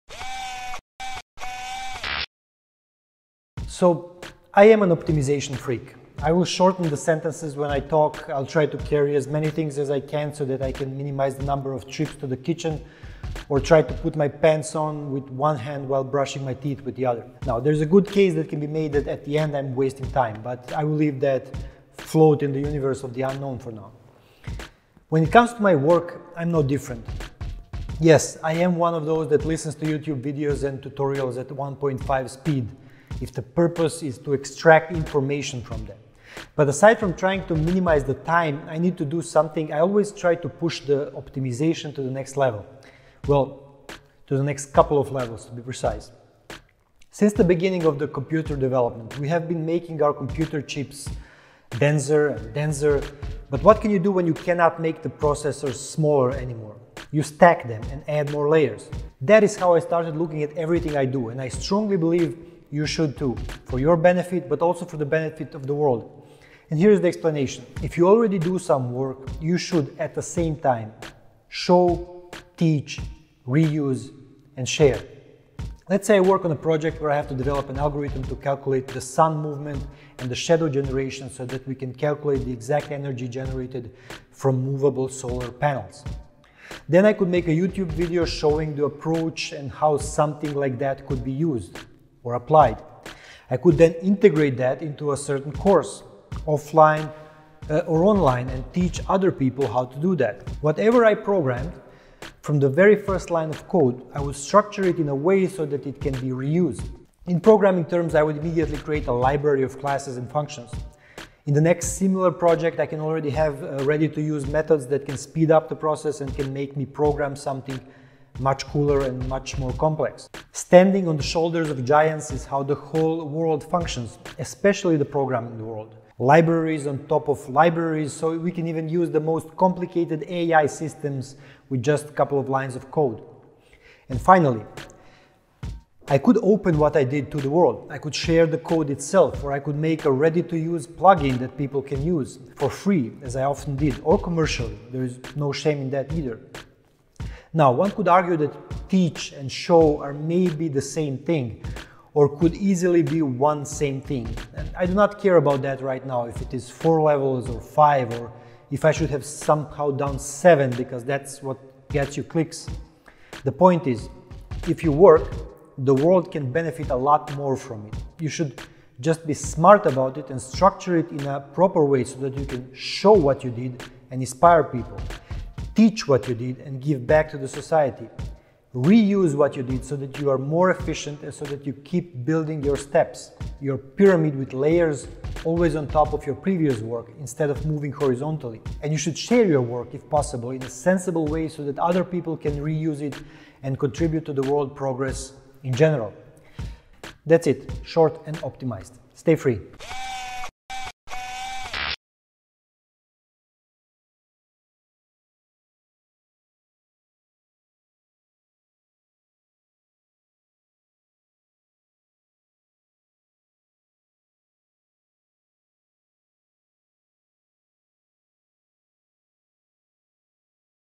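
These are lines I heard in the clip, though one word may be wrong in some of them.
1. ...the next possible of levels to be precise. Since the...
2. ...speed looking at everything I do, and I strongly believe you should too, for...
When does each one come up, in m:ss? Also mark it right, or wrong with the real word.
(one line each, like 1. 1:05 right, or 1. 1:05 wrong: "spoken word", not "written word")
1. 0:44 wrong: "couple", not "possible"
2. 0:59 wrong: "started", not "speed".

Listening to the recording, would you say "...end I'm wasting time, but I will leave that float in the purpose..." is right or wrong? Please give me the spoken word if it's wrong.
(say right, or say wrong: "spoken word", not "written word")
wrong: "universe", not "purpose".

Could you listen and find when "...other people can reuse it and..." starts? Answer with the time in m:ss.
3:11.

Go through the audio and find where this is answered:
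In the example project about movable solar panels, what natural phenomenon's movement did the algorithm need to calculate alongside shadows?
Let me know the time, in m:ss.
1:19.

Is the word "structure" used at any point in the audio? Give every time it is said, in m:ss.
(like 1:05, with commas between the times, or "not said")
1:44, 2:50.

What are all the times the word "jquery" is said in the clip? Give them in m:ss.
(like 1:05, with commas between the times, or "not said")
not said.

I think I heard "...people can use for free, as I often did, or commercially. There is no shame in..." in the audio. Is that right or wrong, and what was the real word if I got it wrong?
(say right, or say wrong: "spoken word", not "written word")
right.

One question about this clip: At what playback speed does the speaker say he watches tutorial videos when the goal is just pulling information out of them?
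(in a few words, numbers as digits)
1.5.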